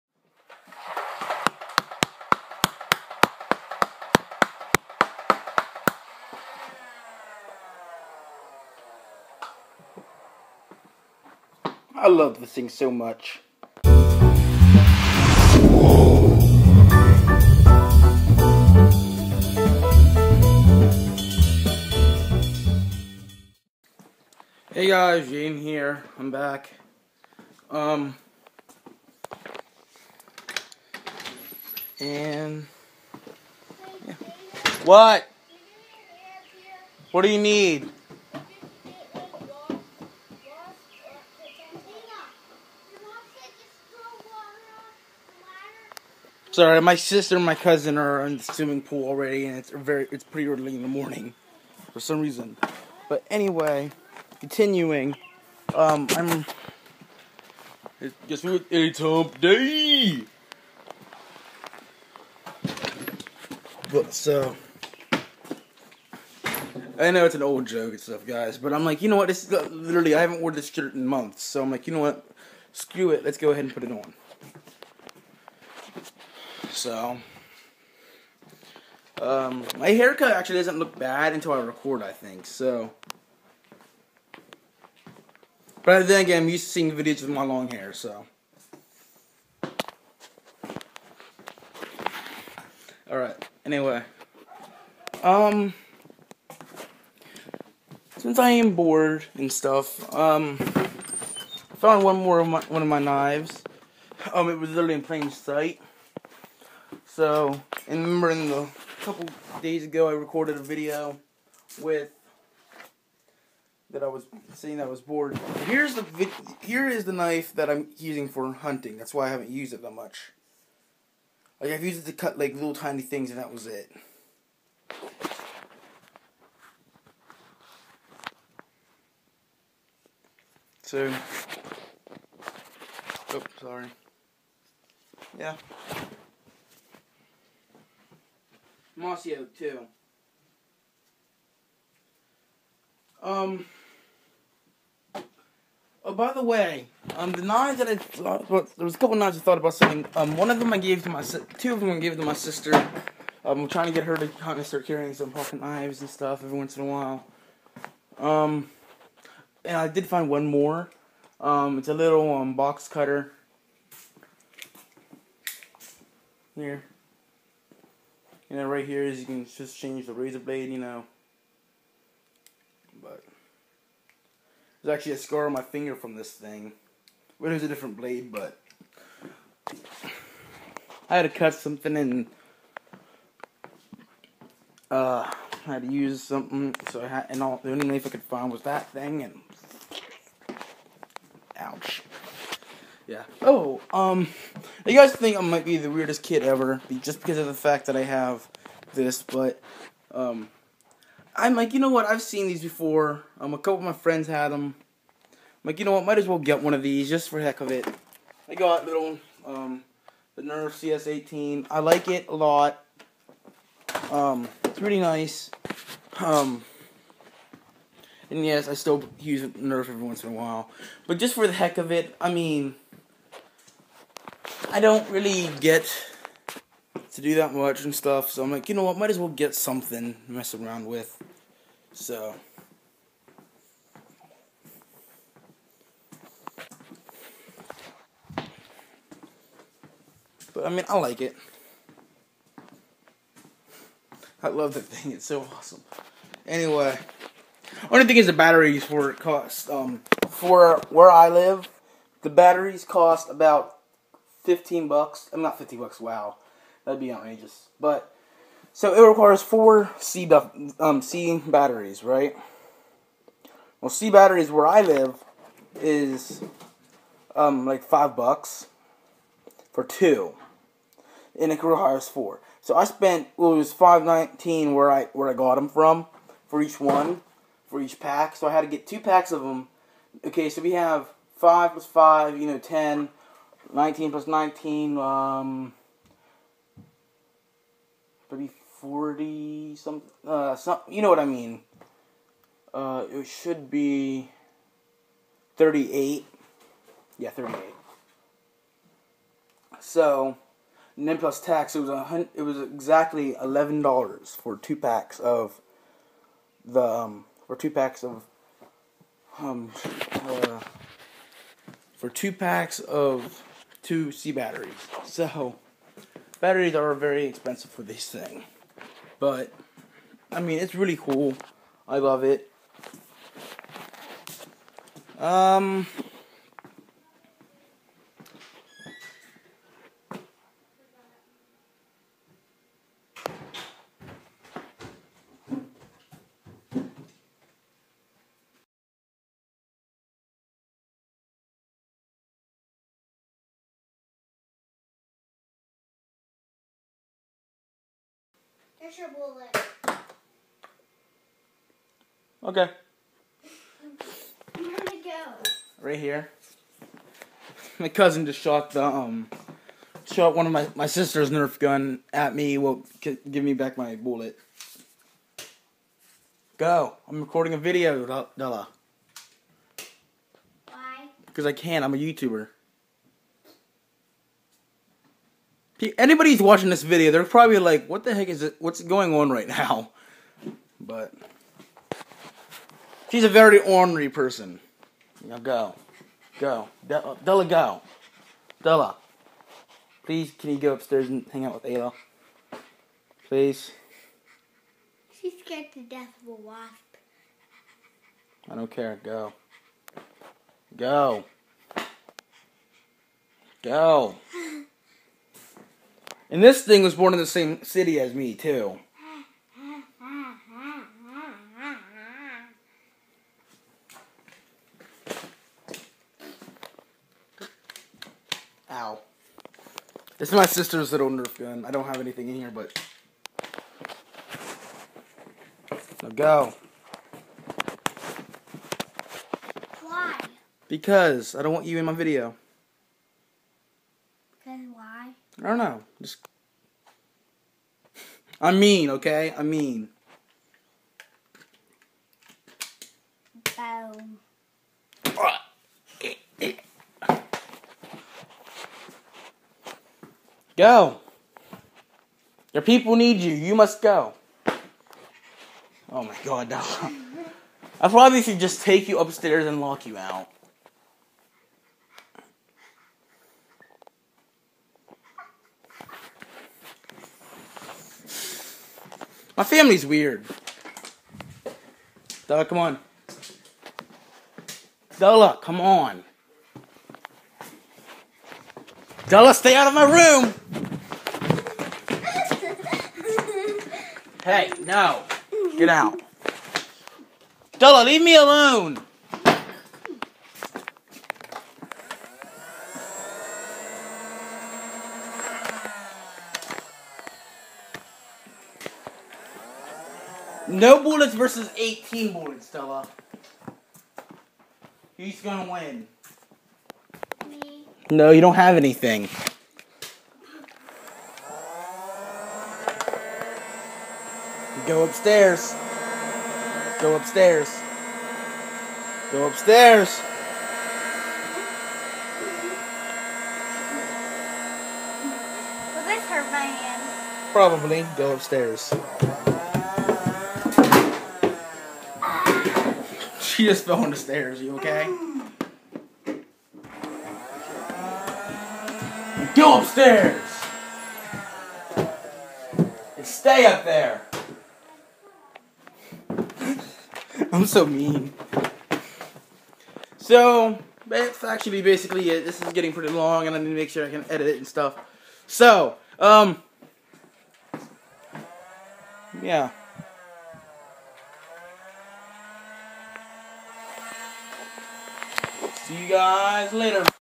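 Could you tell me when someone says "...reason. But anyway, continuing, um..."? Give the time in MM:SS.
00:52.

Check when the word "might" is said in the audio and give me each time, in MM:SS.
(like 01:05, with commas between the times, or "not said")
03:15, 03:26, 03:48.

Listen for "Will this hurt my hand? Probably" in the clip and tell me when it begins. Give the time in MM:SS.
08:45.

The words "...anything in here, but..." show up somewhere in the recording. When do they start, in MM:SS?
07:01.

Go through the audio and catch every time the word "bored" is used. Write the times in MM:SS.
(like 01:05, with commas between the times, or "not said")
01:38, 01:55.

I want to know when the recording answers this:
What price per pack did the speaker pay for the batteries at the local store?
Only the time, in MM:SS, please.
04:33.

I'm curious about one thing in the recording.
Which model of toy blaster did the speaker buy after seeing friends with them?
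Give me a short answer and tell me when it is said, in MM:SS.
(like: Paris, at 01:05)
Nerf CS18, at 03:30.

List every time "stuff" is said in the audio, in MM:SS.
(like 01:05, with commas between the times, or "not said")
01:07, 01:39, 02:36, 03:47, 09:14.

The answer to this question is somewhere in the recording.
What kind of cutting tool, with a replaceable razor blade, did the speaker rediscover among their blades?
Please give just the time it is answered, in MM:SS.
02:42.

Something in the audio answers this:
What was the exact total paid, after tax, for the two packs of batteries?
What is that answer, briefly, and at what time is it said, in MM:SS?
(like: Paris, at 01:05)
$11, at 05:03.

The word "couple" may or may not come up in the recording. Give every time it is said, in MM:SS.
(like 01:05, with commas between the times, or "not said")
01:49, 02:28, 03:23.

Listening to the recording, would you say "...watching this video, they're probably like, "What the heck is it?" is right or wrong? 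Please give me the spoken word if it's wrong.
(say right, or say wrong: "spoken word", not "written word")
right.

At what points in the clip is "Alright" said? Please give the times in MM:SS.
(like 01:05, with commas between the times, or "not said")
01:33.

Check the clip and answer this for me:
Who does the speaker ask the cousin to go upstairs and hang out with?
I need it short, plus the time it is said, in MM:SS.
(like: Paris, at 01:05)
Ayla, at 06:31.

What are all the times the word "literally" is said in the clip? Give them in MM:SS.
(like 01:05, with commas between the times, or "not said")
01:09, 01:44.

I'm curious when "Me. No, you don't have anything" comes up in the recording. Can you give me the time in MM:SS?
08:27.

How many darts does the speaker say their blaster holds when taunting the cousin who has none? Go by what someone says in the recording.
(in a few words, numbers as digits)
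18.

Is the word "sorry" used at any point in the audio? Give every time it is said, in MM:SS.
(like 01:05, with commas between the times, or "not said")
00:46, 02:13.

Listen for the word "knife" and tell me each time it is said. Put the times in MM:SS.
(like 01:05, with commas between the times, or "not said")
01:57, 03:07.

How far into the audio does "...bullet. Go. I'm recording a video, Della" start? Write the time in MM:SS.
06:03.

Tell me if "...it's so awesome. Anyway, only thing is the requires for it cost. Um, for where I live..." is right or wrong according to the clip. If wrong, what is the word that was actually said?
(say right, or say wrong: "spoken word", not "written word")
wrong: "batteries", not "requires".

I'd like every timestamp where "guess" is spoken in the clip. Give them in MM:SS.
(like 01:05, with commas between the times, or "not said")
00:58.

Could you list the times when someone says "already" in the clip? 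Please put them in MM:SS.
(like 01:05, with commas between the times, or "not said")
00:49.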